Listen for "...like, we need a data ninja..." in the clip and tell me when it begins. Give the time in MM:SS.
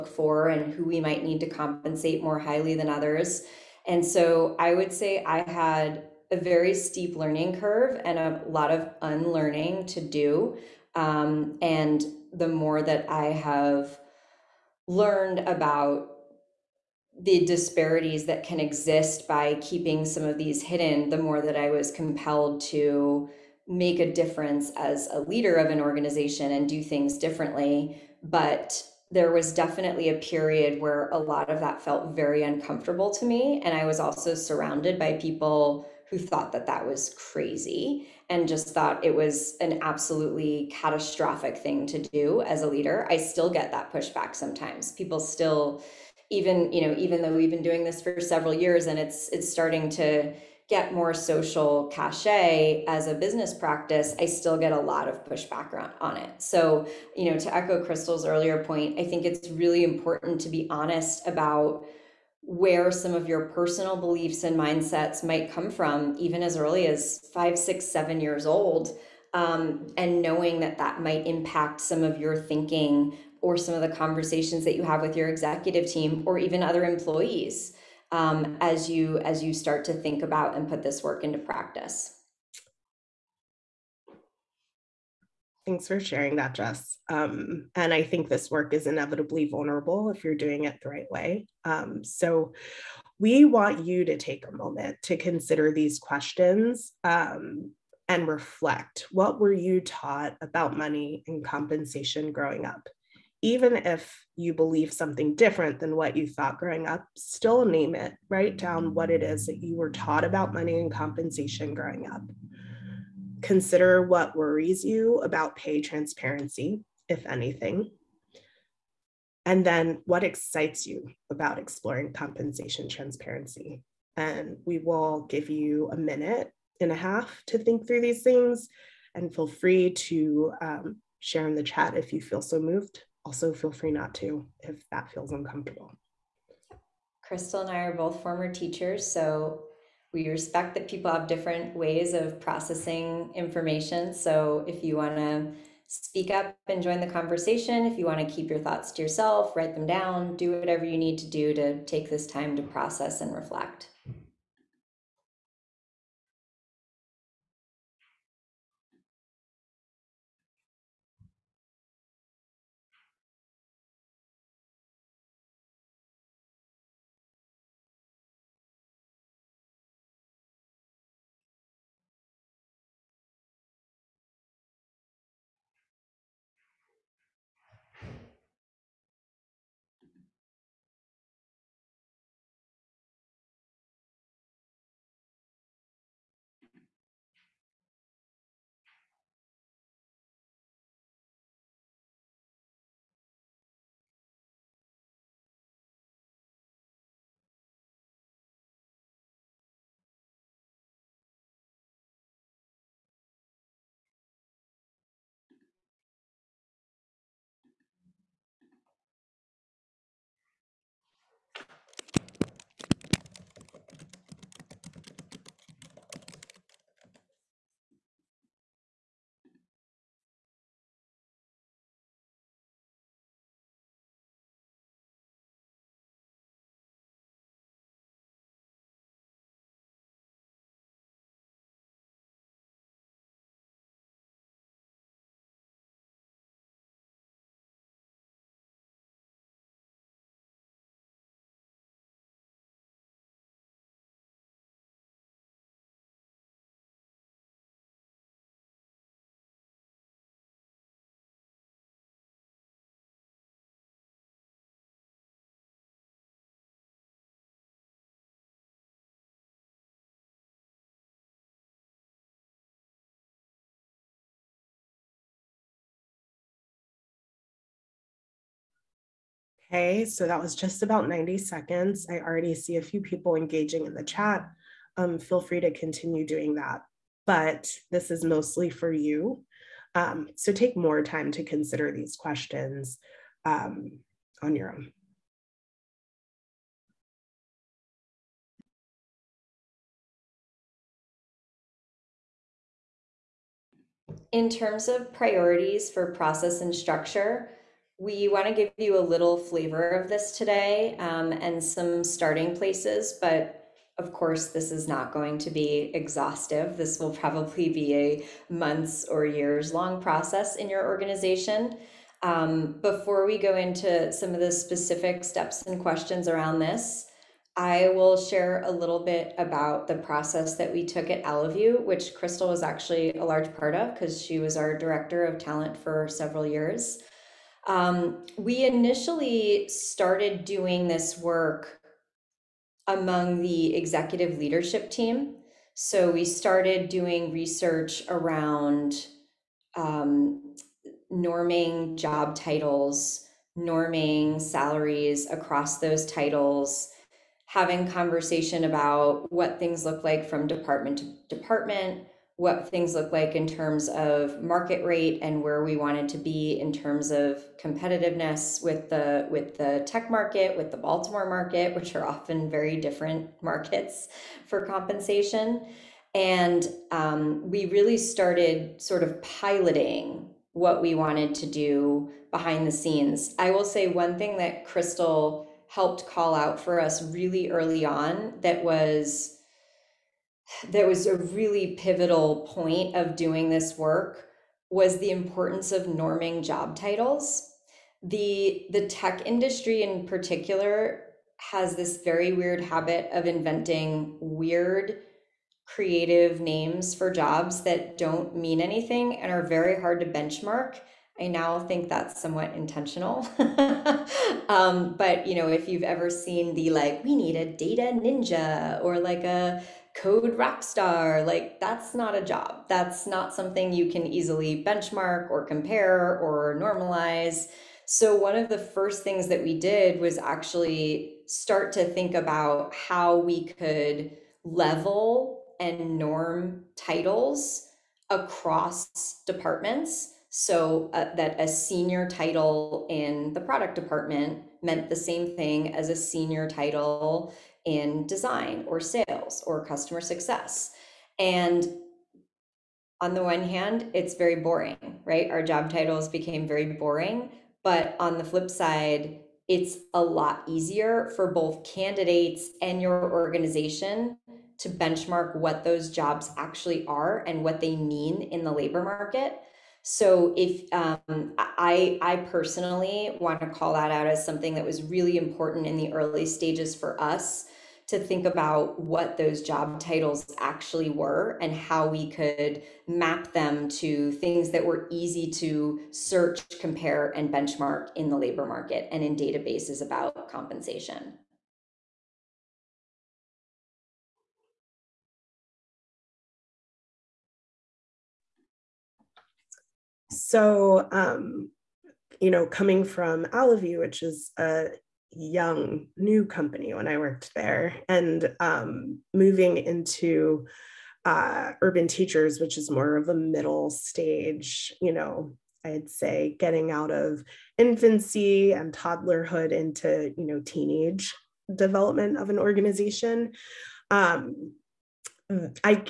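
06:46.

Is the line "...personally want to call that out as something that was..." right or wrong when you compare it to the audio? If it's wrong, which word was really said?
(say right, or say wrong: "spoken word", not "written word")
right.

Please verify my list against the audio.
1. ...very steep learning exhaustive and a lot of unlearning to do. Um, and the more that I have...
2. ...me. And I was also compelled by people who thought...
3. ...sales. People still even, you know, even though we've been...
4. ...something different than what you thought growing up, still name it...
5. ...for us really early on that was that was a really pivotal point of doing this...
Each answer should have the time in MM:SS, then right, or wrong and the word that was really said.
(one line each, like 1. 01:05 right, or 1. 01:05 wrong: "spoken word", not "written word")
1. 00:06 wrong: "curve", not "exhaustive"
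2. 00:33 wrong: "surrounded", not "compelled"
3. 00:44 wrong: "sometimes", not "sales"
4. 01:44 right
5. 06:16 right.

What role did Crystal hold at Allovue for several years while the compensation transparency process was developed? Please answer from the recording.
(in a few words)
Director of talent.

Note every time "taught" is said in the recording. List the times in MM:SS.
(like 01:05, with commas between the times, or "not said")
01:39, 01:49.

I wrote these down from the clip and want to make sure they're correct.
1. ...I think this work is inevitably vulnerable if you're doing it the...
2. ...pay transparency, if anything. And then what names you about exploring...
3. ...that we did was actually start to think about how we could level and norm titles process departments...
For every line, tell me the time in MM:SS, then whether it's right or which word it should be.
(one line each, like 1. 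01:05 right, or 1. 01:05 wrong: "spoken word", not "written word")
1. 01:27 right
2. 01:55 wrong: "excites", not "names"
3. 06:59 wrong: "across", not "process".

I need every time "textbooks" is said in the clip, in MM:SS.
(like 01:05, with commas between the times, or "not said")
not said.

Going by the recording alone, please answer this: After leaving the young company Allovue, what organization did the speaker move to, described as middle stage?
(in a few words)
Urban Teachers.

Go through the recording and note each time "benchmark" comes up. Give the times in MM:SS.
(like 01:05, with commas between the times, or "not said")
06:40, 06:54, 07:34, 07:57.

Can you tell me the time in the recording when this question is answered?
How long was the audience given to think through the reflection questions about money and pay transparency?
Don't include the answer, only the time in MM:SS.
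02:05.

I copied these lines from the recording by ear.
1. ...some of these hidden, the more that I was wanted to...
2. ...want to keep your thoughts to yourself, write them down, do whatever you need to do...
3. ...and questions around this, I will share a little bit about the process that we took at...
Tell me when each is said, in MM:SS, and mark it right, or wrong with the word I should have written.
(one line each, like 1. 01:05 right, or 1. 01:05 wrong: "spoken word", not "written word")
1. 00:20 wrong: "compelled", not "wanted"
2. 02:28 right
3. 05:15 right.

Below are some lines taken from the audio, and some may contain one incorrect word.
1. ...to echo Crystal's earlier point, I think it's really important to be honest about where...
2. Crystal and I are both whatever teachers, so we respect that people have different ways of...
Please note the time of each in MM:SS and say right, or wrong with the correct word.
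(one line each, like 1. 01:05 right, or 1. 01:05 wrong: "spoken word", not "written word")
1. 00:57 right
2. 02:17 wrong: "former", not "whatever".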